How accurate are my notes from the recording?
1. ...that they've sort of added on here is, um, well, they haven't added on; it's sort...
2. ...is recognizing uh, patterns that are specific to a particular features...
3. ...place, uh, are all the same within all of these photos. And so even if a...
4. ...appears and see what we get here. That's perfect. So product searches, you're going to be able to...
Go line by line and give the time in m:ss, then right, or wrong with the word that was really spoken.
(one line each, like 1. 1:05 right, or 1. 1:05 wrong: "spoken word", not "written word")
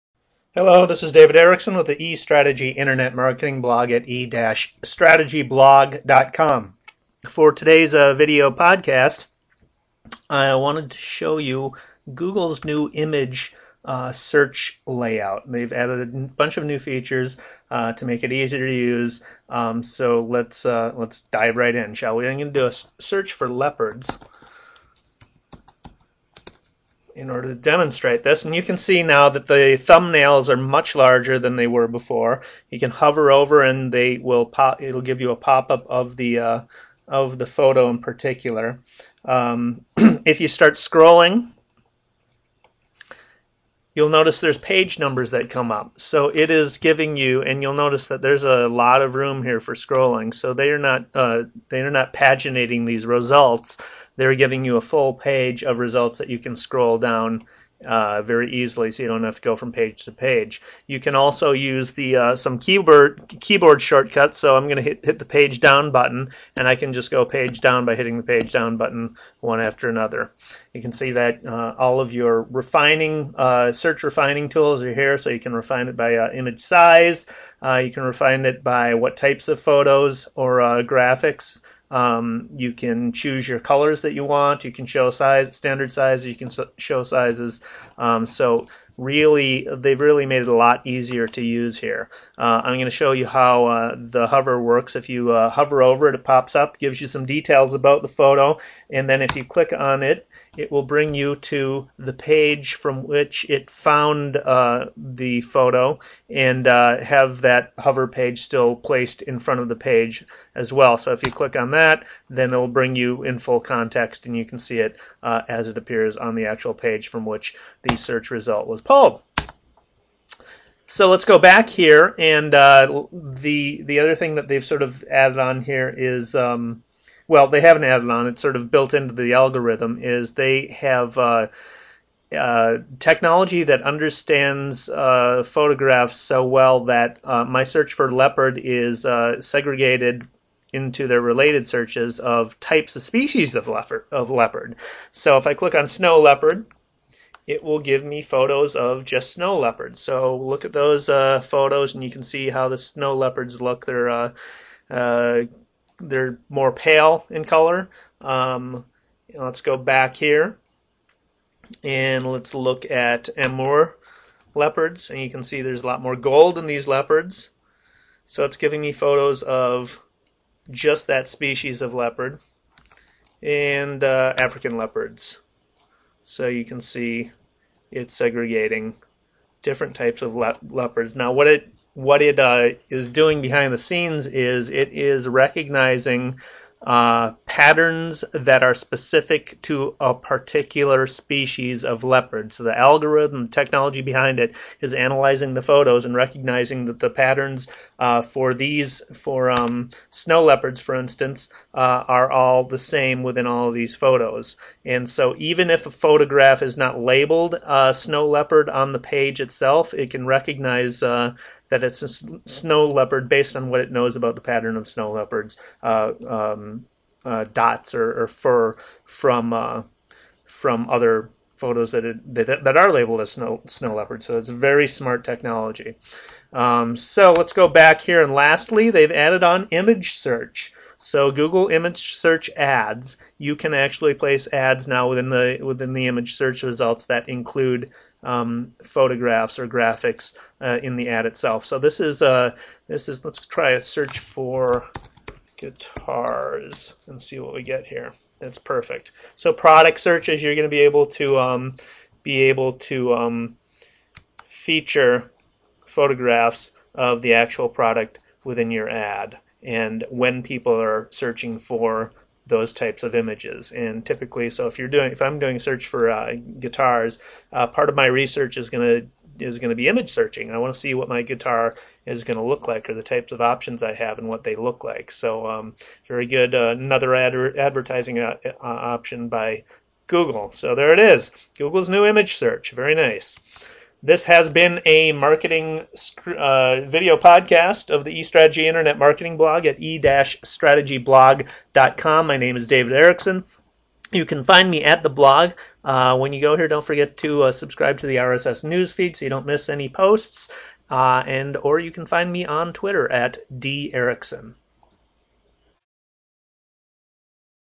1. 2:04 right
2. 3:04 wrong: "species", not "features"
3. 3:20 wrong: "instance", not "place"
4. 4:05 wrong: "guitars", not "appears".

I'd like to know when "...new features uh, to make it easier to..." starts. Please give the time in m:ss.
0:16.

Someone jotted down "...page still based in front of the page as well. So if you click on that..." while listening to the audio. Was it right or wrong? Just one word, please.
wrong.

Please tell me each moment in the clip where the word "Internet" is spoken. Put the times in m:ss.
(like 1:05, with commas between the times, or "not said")
0:02, 4:48.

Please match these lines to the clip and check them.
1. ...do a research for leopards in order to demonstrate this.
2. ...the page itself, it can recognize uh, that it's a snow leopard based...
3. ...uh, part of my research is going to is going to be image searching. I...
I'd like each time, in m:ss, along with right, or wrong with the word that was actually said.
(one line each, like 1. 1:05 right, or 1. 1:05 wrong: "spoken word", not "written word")
1. 0:22 wrong: "search", not "research"
2. 3:28 right
3. 4:27 right.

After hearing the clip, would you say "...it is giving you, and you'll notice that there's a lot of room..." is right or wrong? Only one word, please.
right.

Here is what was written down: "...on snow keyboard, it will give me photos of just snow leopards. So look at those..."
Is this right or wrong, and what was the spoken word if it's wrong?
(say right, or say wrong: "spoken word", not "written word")
wrong: "leopard", not "keyboard".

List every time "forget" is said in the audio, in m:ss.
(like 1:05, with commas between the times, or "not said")
4:56.